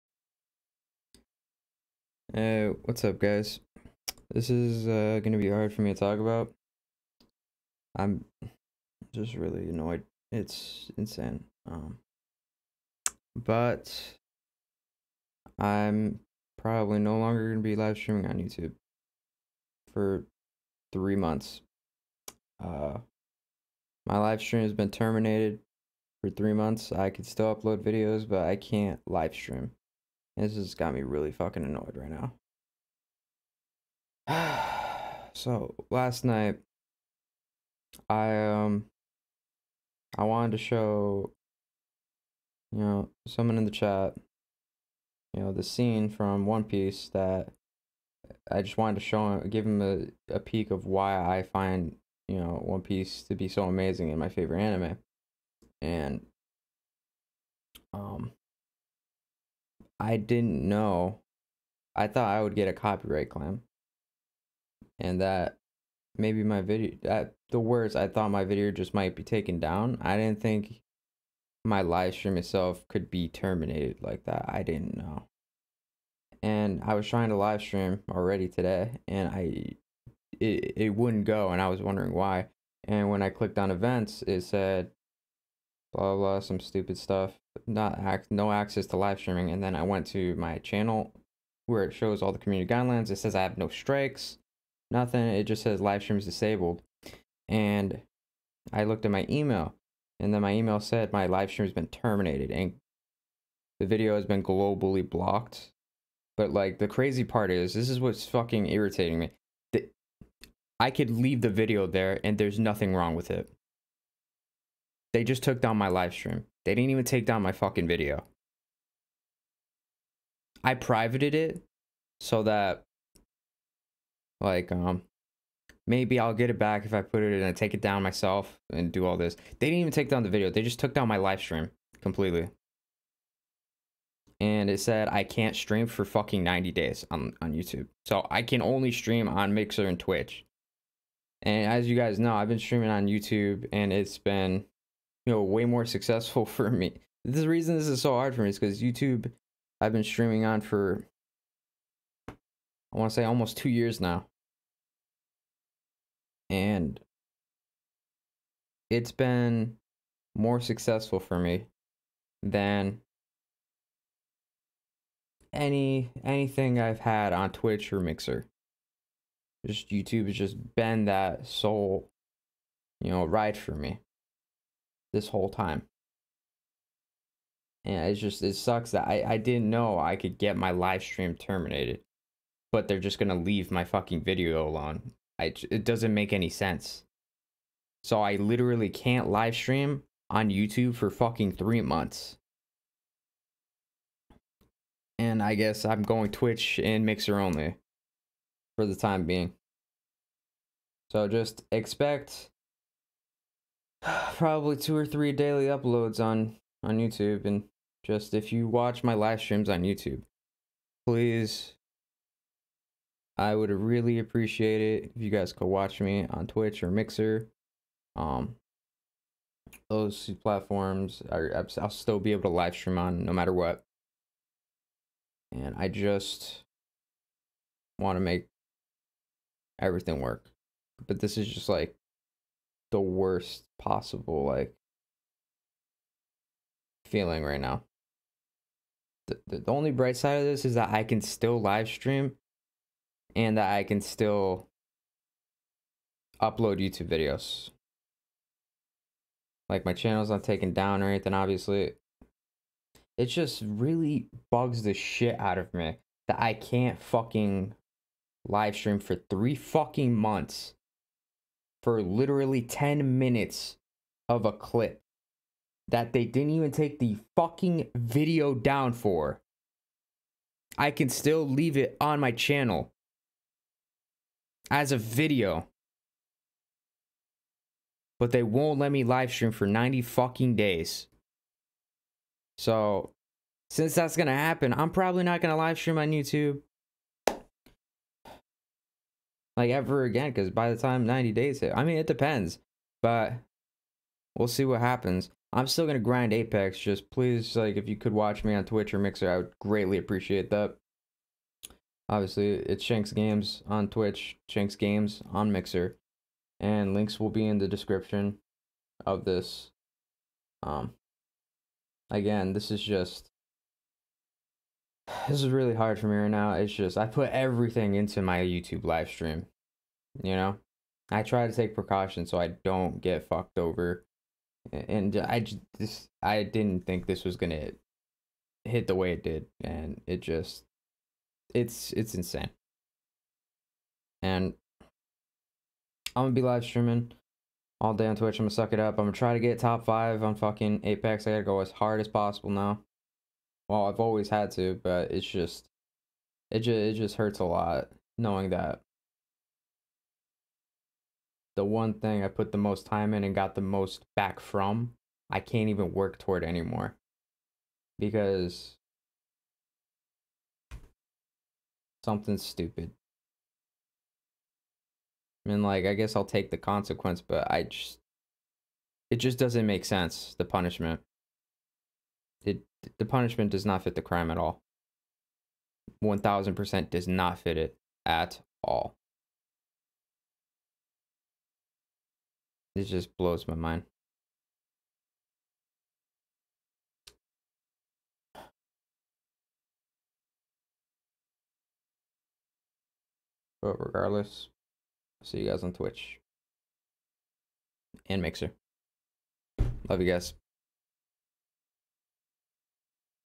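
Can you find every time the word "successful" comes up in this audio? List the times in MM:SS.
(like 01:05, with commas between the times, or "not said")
02:25, 02:40.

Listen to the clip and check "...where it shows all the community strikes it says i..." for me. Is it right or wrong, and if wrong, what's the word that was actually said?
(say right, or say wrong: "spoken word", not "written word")
wrong: "guidelines", not "strikes".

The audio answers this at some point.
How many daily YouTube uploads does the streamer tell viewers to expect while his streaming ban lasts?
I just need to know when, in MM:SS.
03:24.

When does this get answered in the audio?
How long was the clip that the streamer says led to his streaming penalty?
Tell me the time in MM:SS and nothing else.
04:22.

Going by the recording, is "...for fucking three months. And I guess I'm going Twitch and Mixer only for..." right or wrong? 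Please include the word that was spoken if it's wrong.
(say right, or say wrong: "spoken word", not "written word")
right.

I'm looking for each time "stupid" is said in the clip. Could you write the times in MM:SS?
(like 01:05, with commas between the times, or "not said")
01:26, 06:02.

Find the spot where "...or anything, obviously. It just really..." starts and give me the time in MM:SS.
04:11.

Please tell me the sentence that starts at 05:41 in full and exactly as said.
I gotta go as hard as possible now.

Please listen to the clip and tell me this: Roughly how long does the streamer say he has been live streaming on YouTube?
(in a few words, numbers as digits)
almost 2 years.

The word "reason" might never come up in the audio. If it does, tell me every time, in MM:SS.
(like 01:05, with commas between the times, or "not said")
02:27.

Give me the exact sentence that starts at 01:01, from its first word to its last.
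I thought I would get a copyright claim.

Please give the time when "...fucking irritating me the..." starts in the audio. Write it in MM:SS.
01:48.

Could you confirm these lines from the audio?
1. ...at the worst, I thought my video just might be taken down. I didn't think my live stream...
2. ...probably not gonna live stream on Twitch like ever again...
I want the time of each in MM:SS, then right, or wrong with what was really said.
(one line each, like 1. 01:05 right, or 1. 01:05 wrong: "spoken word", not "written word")
1. 01:07 right
2. 04:44 wrong: "YouTube", not "Twitch".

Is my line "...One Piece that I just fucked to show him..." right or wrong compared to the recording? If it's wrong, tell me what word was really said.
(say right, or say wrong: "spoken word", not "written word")
wrong: "wanted", not "fucked".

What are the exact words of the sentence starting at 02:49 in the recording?
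Just YouTube has just been that sole, you know, ride for me this whole time.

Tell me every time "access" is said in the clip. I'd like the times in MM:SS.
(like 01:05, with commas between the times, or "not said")
01:28.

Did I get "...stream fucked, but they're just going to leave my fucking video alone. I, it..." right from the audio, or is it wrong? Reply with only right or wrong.
wrong.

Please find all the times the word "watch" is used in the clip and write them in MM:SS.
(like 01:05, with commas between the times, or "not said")
03:28, 03:35, 04:58.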